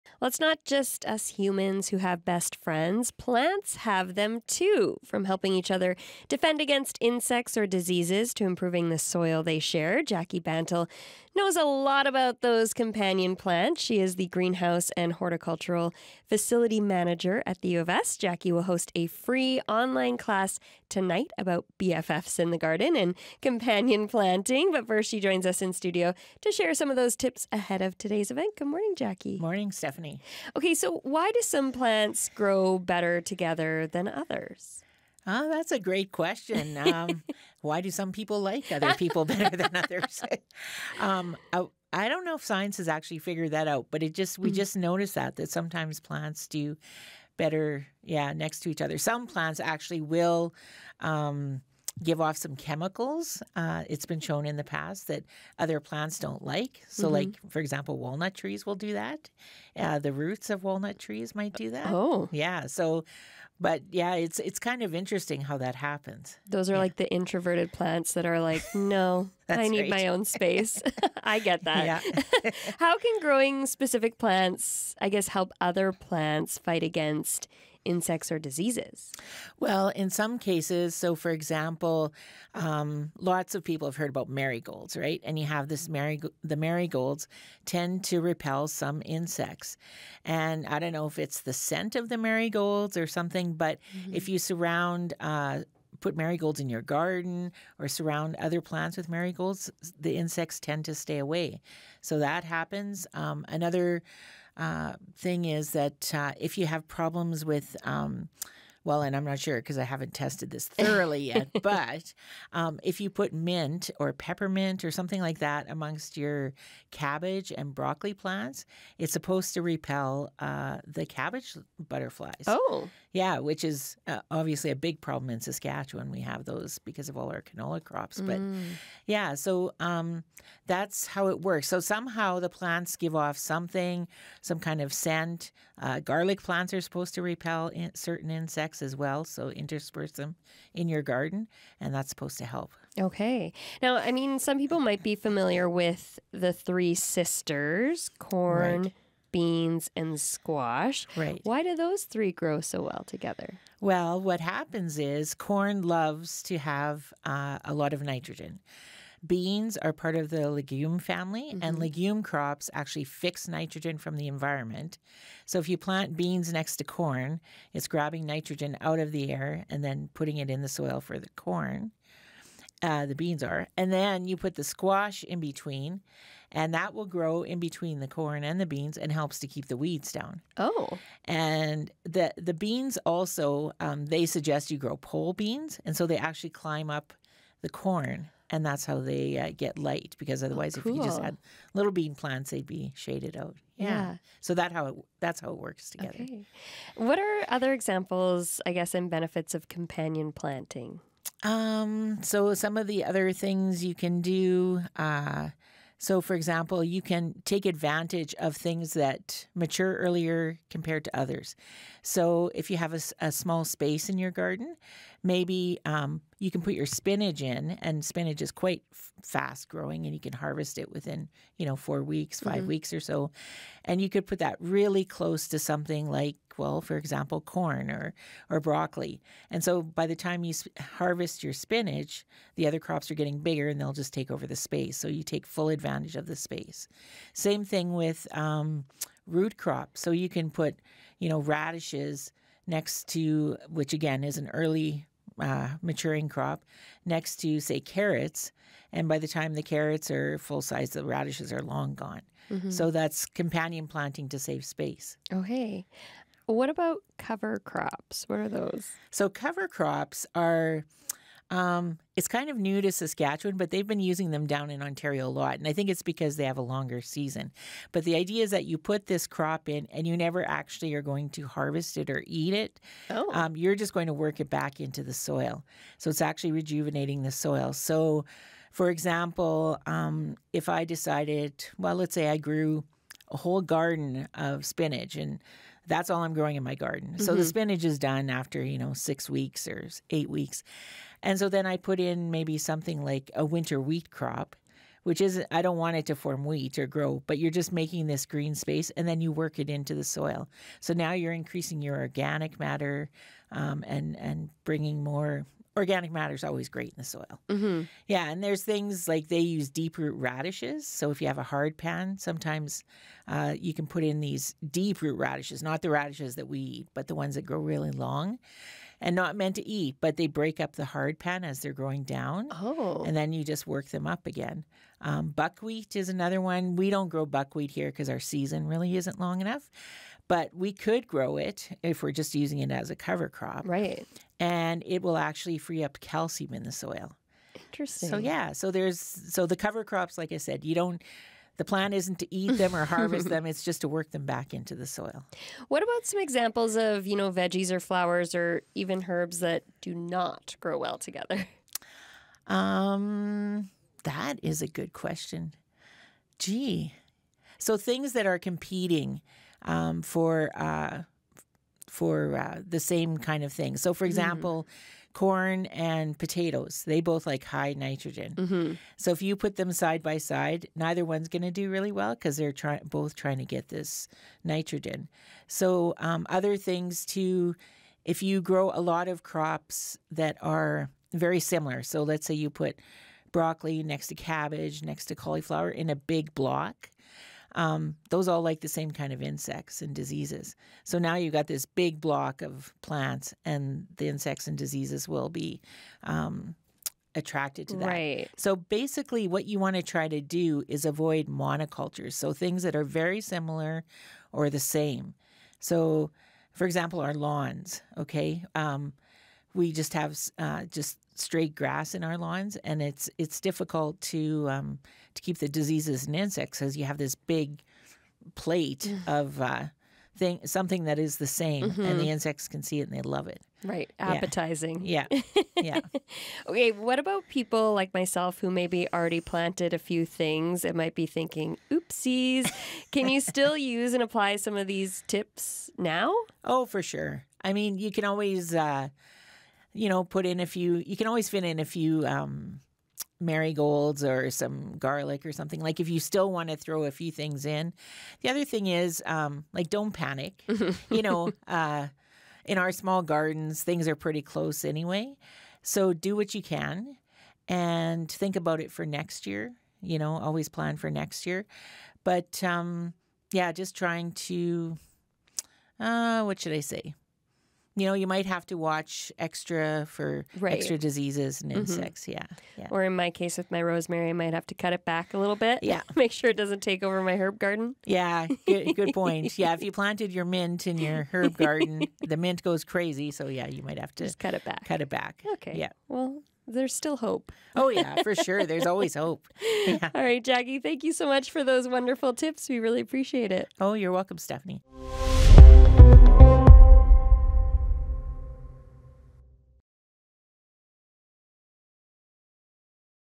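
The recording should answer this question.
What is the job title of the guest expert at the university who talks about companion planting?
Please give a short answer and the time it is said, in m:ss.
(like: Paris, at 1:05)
Greenhouse and horticultural facility manager, at 0:14.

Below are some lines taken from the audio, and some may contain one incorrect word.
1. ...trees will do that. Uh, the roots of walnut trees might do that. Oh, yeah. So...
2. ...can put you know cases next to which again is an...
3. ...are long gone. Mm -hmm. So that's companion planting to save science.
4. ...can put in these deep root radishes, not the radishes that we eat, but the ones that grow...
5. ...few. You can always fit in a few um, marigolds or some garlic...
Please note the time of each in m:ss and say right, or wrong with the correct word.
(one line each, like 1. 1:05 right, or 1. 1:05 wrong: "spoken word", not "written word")
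1. 0:58 right
2. 4:00 wrong: "radishes", not "cases"
3. 4:11 wrong: "space", not "science"
4. 5:13 right
5. 7:20 right.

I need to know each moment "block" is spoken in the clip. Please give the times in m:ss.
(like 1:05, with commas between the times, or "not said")
6:26, 6:31.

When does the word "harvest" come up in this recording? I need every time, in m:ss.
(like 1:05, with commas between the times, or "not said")
3:40, 3:50, 4:31, 5:42.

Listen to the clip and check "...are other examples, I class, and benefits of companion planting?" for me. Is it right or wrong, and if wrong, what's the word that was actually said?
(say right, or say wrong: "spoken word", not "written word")
wrong: "guess", not "class".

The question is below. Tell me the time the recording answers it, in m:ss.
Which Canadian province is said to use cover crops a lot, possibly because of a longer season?
4:24.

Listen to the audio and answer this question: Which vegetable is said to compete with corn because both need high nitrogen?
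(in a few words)
Potatoes.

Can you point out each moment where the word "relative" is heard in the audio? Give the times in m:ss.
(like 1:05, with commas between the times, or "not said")
not said.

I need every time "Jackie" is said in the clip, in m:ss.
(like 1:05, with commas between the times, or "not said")
0:10, 0:18, 0:28, 8:10.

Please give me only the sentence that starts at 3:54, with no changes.
So you take full advantage of the space.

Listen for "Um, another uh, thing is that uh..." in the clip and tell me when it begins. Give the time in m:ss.
1:43.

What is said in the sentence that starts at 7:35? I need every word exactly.
So do what you can and think about it for next year.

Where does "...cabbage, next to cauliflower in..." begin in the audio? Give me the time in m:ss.
6:24.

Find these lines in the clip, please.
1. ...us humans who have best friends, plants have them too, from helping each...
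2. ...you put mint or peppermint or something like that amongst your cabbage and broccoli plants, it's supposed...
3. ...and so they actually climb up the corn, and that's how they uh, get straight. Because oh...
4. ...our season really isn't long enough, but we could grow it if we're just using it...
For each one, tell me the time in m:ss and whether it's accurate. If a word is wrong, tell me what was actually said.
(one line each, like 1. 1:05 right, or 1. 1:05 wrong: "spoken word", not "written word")
1. 0:01 right
2. 1:52 right
3. 3:05 wrong: "light", not "straight"
4. 5:28 right.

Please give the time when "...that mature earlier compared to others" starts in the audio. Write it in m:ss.
3:28.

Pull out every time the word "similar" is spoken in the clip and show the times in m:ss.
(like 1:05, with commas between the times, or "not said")
6:21, 6:43.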